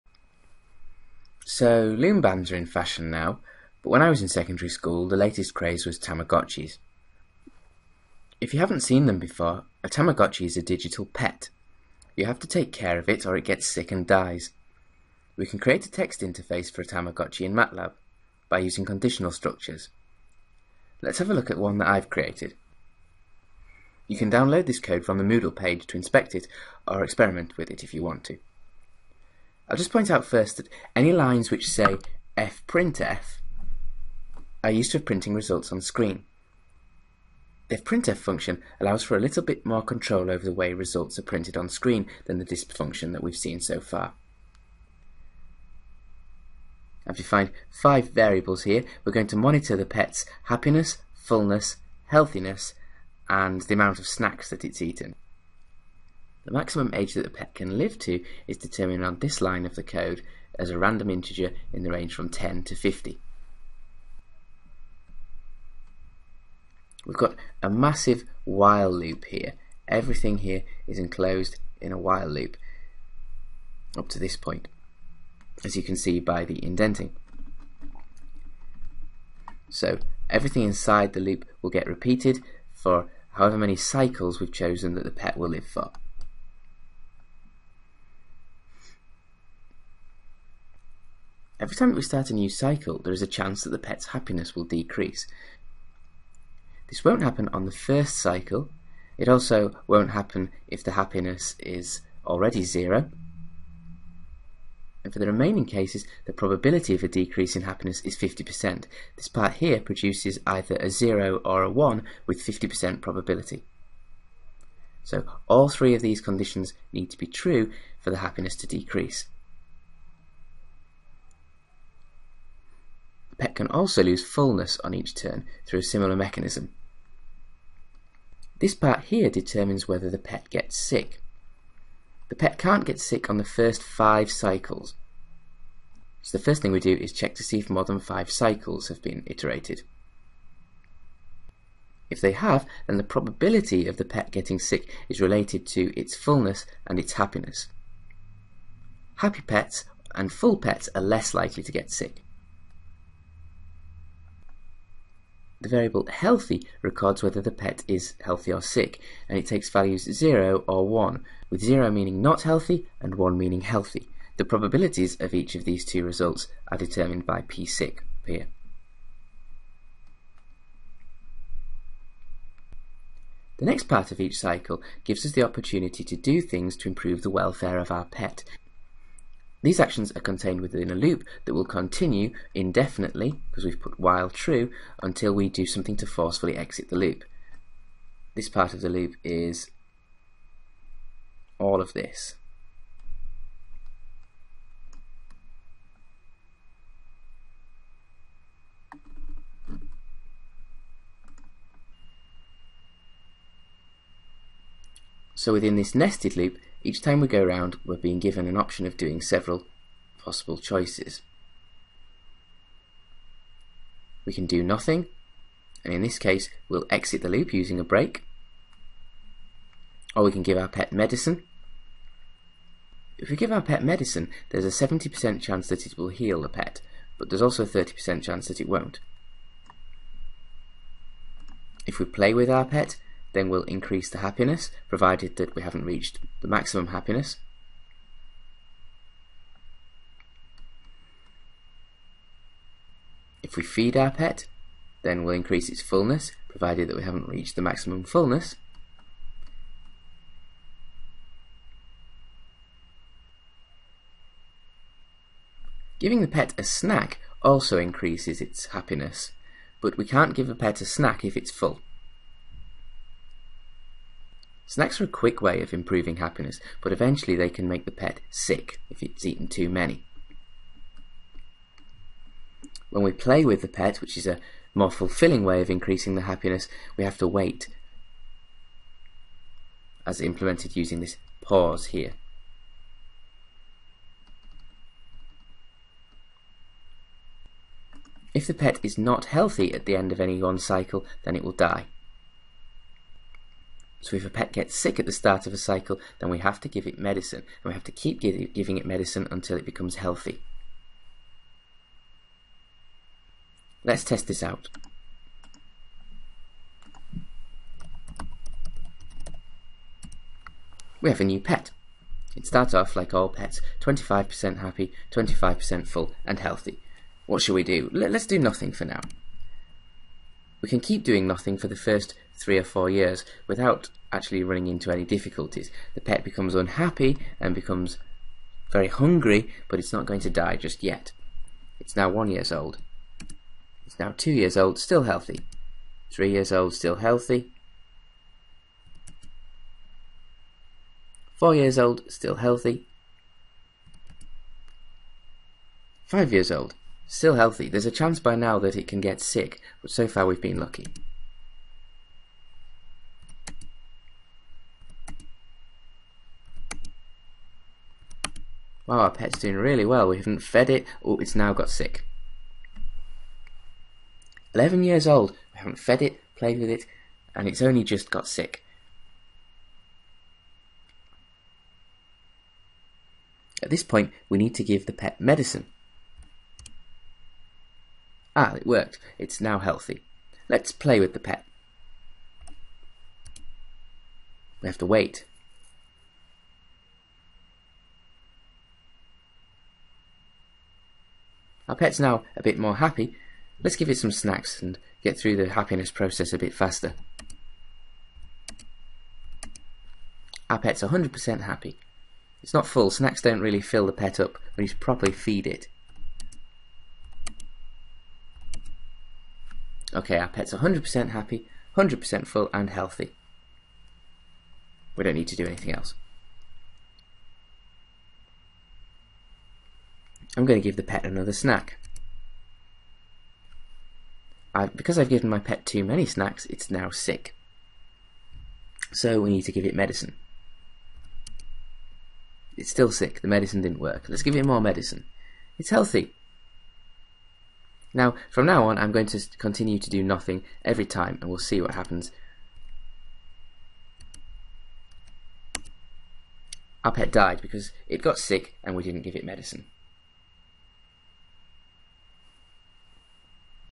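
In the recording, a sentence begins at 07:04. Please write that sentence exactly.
I've, because I've given my pet too many snacks, it's now sick.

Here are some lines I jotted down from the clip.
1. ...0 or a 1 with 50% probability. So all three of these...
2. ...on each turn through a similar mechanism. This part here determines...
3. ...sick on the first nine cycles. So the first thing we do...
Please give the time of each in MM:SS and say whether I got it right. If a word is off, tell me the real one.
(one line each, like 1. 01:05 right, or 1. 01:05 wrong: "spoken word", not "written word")
1. 01:50 right
2. 02:04 right
3. 02:12 wrong: "five", not "nine".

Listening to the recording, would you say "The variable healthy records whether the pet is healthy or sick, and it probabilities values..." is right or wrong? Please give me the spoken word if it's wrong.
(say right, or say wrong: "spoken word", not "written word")
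wrong: "takes", not "probabilities".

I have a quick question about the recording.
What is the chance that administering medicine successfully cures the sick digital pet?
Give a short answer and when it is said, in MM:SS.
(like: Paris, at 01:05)
70%, at 03:44.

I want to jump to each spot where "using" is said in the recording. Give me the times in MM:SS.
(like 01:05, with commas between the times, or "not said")
00:18, 03:37, 04:40.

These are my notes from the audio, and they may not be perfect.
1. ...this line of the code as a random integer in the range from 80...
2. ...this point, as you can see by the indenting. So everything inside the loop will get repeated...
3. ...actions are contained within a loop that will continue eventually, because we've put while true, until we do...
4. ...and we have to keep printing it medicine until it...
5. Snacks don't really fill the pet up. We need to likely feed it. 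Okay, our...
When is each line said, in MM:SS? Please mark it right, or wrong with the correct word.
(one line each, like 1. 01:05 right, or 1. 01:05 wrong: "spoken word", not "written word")
1. 00:59 wrong: "10", not "80"
2. 01:14 right
3. 02:59 wrong: "indefinitely", not "eventually"
4. 04:57 wrong: "giving", not "printing"
5. 06:42 wrong: "properly", not "likely".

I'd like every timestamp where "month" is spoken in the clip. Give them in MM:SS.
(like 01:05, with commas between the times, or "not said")
not said.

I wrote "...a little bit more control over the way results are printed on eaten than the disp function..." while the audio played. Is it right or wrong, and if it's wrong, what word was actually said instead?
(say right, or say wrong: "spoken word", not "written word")
wrong: "screen", not "eaten".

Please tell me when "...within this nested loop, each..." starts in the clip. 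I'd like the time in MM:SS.
03:25.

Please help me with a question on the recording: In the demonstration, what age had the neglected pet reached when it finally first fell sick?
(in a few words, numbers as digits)
11 years old.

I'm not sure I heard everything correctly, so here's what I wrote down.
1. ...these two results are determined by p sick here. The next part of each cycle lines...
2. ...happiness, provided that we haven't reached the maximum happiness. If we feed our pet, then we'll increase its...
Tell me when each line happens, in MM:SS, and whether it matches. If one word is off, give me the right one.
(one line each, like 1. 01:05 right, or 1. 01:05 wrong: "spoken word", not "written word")
1. 02:45 wrong: "gives", not "lines"
2. 03:54 right.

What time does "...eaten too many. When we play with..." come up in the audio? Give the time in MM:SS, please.
04:29.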